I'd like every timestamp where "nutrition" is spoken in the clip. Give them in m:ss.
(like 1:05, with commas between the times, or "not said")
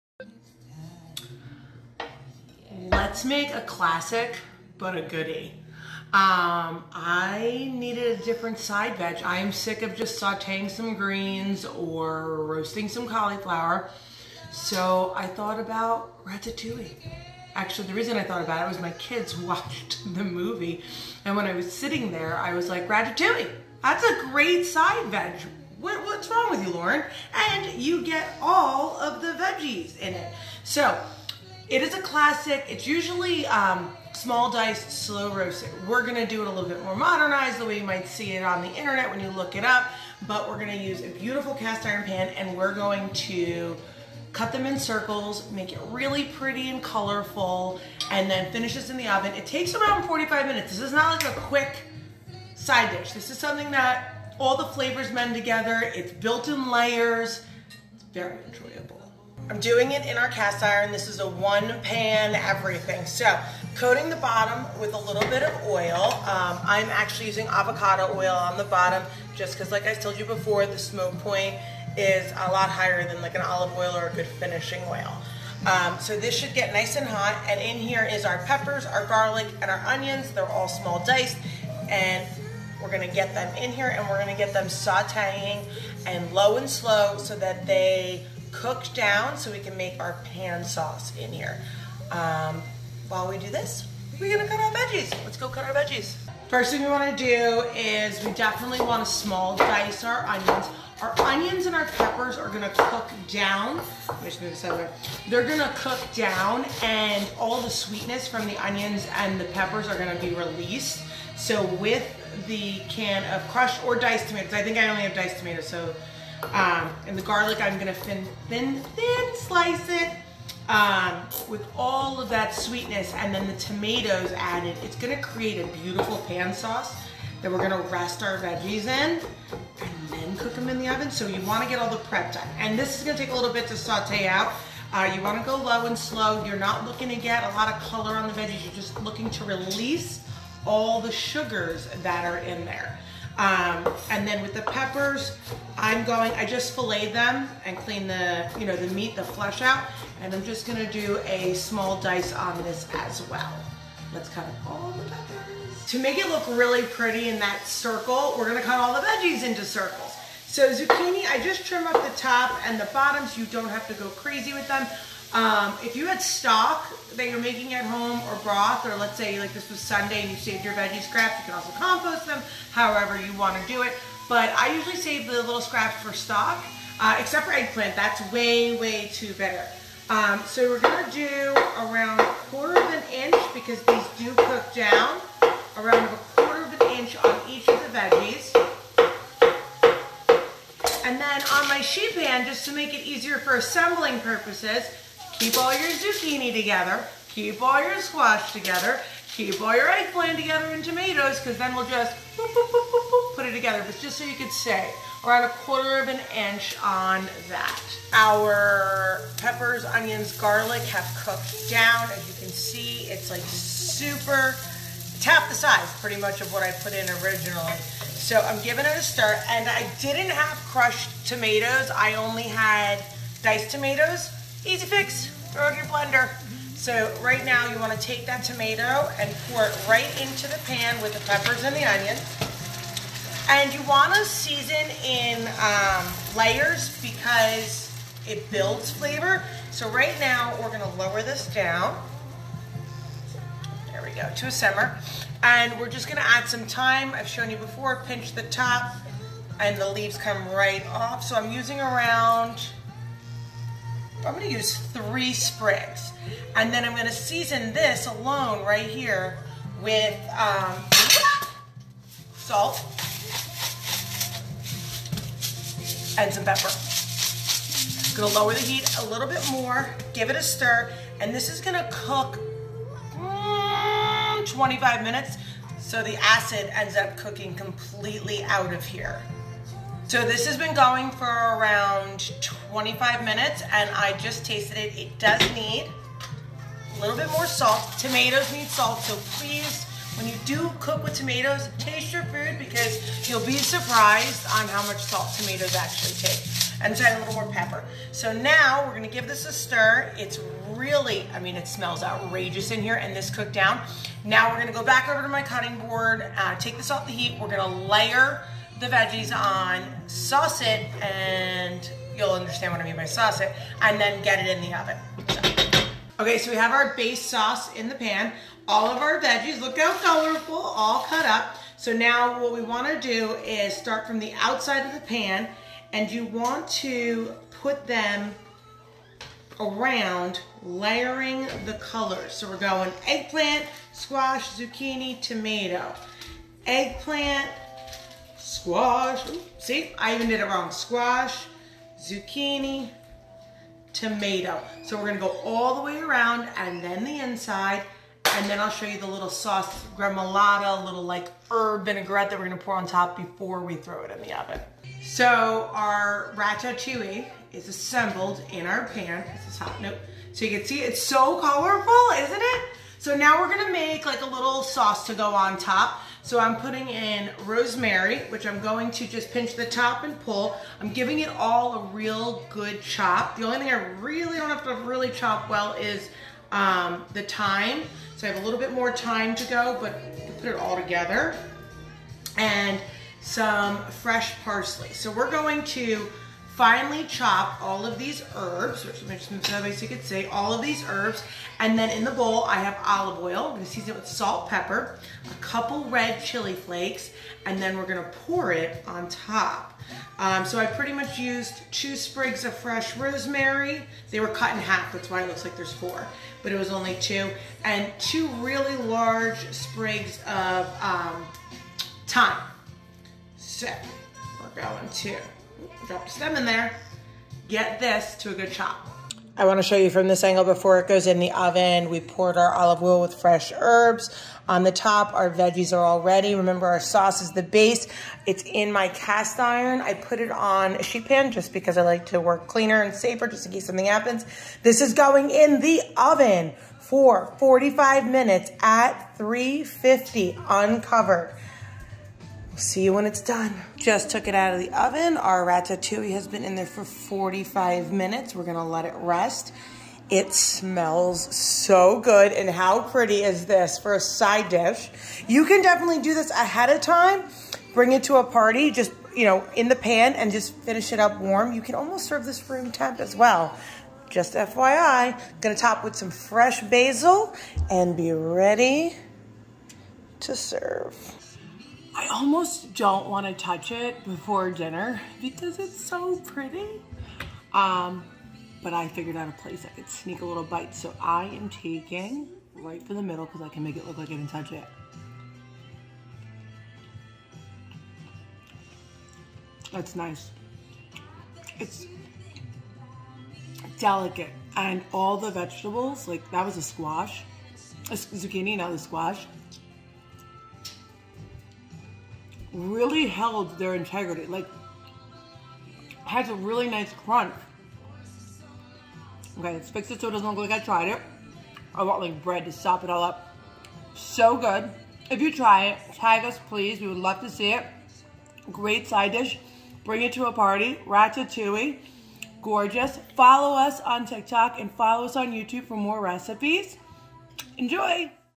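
not said.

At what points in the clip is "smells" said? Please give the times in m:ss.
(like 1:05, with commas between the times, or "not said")
5:01, 7:30.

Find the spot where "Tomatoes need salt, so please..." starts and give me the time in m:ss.
4:47.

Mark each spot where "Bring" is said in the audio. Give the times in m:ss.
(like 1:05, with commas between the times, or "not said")
7:37, 8:39.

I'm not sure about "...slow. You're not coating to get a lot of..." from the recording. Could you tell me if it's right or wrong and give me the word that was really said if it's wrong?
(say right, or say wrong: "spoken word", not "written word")
wrong: "looking", not "coating".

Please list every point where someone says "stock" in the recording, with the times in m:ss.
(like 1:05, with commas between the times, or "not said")
2:46, 2:56.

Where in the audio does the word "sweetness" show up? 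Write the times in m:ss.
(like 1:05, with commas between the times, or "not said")
1:47, 2:02.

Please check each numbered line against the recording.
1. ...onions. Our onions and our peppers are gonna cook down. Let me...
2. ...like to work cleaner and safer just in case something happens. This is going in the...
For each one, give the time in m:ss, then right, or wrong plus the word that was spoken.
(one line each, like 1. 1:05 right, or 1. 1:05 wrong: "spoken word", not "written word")
1. 1:40 right
2. 7:11 right.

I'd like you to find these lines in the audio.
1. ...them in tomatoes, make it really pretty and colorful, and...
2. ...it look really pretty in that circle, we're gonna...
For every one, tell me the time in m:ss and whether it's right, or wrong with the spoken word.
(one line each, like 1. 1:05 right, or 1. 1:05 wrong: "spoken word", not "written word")
1. 0:44 wrong: "circles", not "tomatoes"
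2. 2:36 right.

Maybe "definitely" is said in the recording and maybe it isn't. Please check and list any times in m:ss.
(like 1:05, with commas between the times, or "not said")
1:38, 7:35.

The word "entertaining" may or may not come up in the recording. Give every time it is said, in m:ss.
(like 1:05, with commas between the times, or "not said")
not said.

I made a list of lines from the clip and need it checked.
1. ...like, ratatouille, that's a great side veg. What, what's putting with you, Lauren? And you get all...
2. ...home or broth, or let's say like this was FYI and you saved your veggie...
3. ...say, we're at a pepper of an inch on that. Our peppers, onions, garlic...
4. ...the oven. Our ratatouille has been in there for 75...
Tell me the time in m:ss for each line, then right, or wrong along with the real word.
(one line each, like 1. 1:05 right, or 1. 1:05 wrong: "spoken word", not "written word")
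1. 0:22 wrong: "wrong", not "putting"
2. 2:47 wrong: "Sunday", not "FYI"
3. 3:24 wrong: "quarter", not "pepper"
4. 7:24 wrong: "45", not "75".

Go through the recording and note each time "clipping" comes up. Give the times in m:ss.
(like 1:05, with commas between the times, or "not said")
not said.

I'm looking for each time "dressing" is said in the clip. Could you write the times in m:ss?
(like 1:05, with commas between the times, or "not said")
not said.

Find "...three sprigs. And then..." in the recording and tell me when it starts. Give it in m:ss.
4:14.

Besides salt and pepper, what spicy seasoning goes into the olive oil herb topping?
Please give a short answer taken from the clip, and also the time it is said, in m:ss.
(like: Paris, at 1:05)
red chili flakes, at 6:35.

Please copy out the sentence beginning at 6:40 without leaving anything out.
Um, so I pretty much used two sprigs of fresh rosemary.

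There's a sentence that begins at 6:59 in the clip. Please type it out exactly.
I want to show you from this angle before it goes in the oven.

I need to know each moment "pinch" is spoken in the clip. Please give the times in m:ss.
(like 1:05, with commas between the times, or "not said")
4:08, 6:09.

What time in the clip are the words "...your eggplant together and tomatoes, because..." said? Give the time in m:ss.
3:19.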